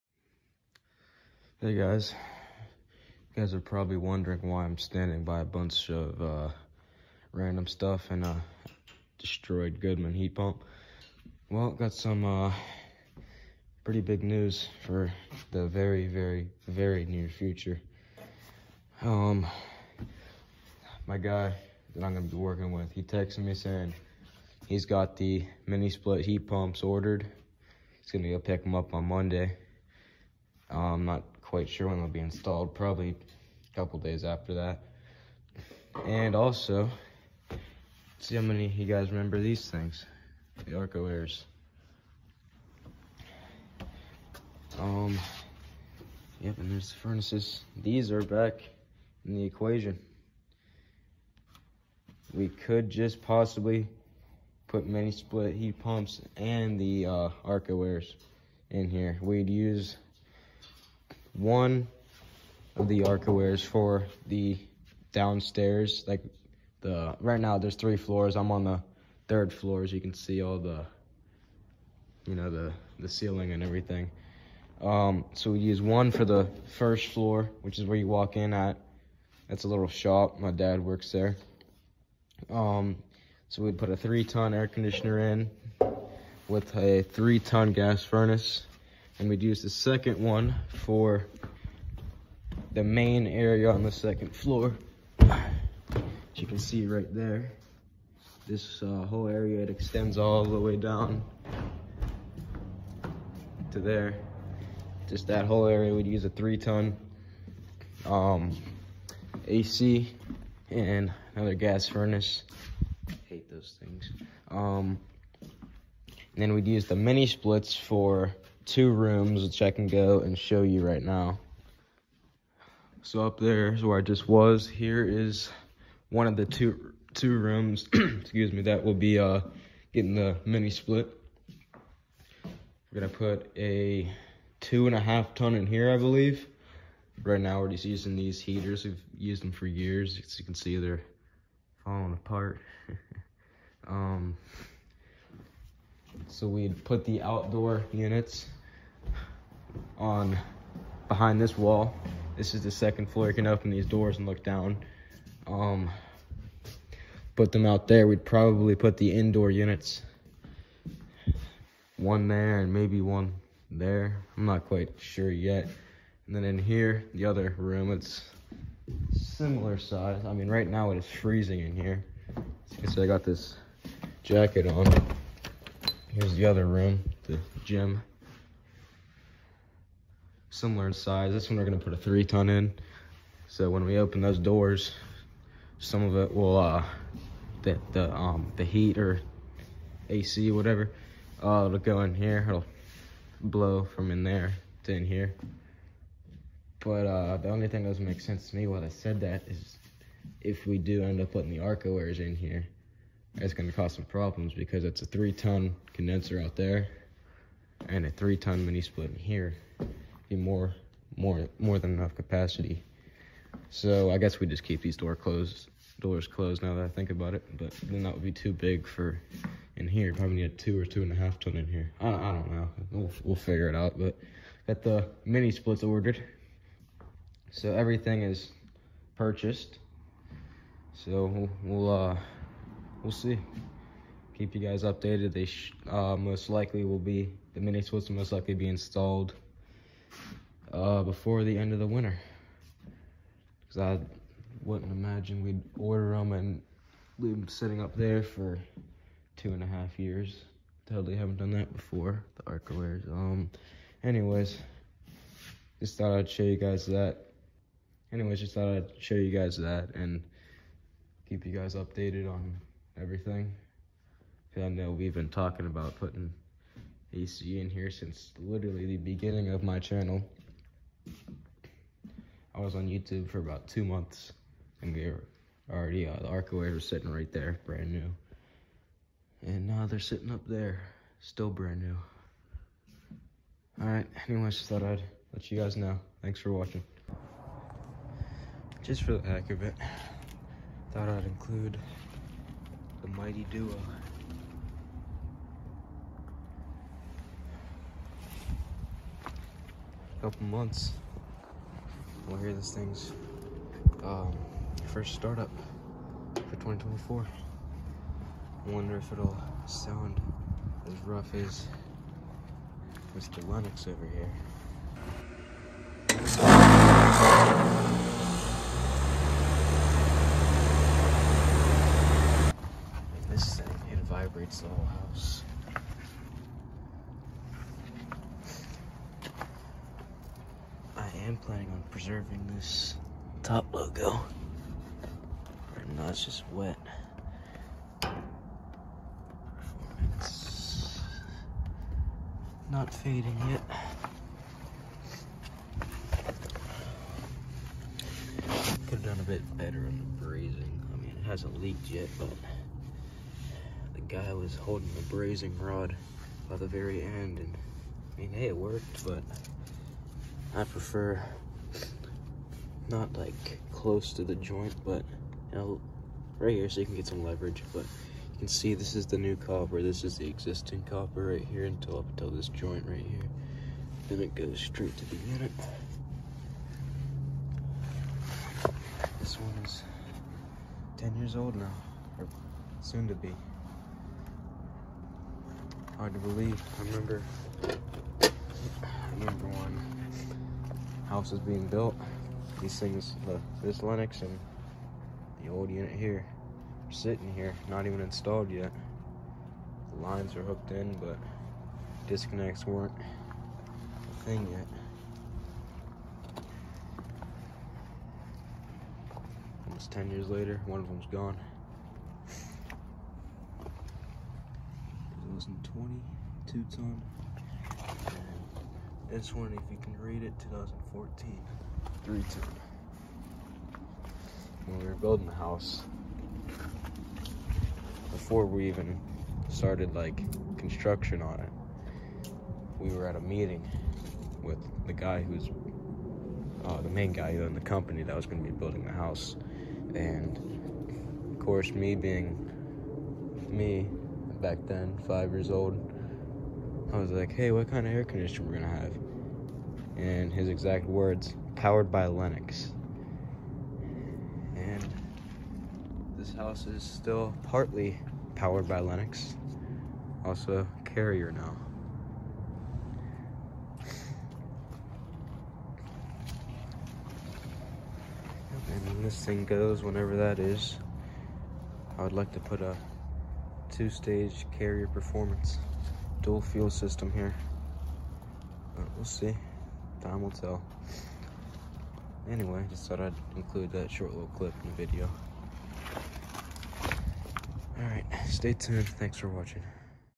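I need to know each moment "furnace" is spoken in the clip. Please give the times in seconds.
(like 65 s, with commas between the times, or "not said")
46 s, 88 s, 111 s.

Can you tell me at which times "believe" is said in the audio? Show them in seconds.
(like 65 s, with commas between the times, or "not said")
135 s, 386 s.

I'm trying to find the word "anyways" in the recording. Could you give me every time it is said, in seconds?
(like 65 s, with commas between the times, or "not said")
254 s, 258 s, 284 s, 482 s.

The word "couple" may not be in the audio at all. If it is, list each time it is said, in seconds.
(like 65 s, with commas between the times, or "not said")
33 s, 300 s.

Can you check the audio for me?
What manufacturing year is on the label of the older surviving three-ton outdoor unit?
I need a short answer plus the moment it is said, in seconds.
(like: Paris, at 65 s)
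2014, at 420 s.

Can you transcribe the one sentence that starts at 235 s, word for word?
They uh, most likely will be, the mini splits will most likely be installed uh, before the end of the winter.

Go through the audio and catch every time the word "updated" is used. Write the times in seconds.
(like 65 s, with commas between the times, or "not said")
234 s, 261 s.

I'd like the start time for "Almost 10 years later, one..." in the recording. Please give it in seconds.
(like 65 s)
409 s.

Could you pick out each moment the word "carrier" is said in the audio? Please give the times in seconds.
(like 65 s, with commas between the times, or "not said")
460 s, 474 s.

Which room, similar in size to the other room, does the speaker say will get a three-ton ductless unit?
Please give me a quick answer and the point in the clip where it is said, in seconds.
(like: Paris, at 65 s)
The gym, at 177 s.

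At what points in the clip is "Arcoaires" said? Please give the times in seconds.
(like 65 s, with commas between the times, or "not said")
40 s, 57 s, 63 s, 201 s, 276 s.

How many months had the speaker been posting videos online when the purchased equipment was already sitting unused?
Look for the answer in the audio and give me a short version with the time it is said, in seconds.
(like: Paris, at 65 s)
2, at 273 s.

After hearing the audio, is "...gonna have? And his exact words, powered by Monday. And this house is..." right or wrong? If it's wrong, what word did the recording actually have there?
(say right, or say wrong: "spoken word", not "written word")
wrong: "Lennox", not "Monday".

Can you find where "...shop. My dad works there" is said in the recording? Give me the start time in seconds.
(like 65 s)
79 s.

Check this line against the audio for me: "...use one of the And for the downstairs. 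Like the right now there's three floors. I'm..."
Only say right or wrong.
wrong.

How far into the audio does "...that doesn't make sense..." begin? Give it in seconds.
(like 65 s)
197 s.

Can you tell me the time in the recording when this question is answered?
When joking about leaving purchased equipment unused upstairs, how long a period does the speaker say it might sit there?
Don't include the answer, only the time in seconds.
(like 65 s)
249 s.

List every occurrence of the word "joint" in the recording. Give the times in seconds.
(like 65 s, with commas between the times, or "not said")
364 s, 372 s.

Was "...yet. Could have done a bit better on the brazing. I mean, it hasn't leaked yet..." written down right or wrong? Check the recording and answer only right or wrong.
right.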